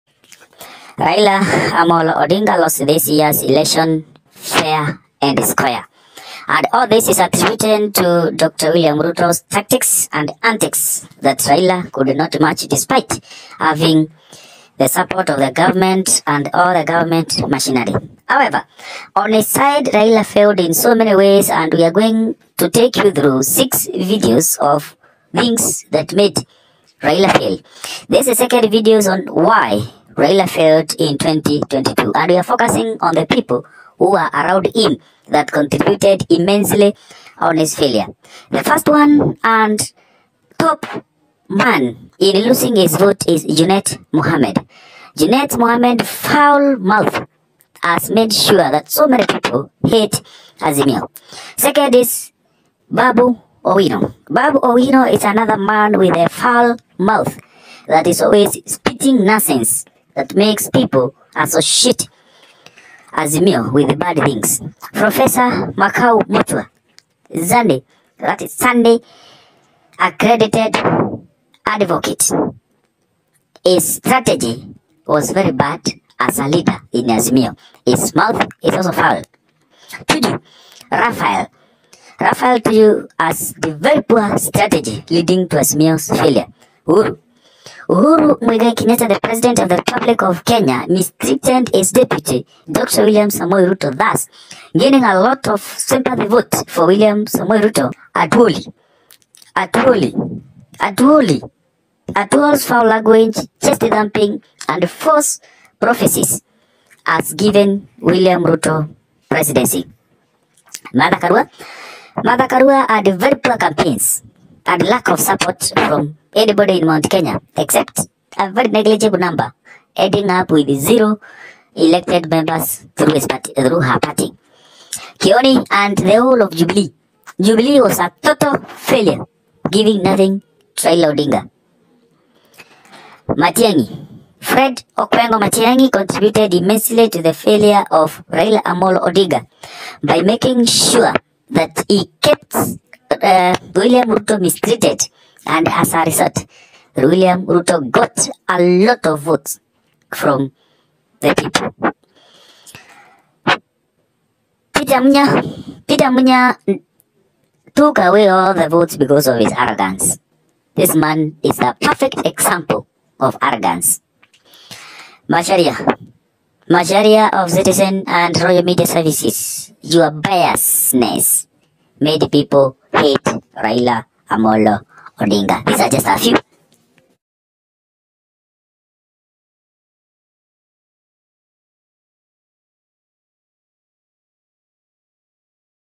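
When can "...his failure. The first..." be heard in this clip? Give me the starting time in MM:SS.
00:37.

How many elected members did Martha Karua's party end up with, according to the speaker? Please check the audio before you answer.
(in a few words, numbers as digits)
0.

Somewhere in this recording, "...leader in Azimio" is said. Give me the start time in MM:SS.
01:16.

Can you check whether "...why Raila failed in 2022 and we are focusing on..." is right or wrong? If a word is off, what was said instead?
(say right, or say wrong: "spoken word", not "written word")
right.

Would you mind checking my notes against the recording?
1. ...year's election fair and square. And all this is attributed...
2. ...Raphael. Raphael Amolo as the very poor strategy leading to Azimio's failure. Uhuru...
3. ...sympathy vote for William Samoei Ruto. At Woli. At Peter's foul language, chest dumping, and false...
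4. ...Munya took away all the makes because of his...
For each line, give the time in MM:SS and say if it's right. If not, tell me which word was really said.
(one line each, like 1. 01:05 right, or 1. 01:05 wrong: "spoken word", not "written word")
1. 00:03 right
2. 01:20 wrong: "Tuju", not "Amolo"
3. 01:35 wrong: "Woli", not "Peter"
4. 02:36 wrong: "votes", not "makes".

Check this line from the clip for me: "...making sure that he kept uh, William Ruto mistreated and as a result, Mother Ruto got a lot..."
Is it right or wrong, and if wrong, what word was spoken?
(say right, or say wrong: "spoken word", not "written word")
wrong: "William", not "Mother".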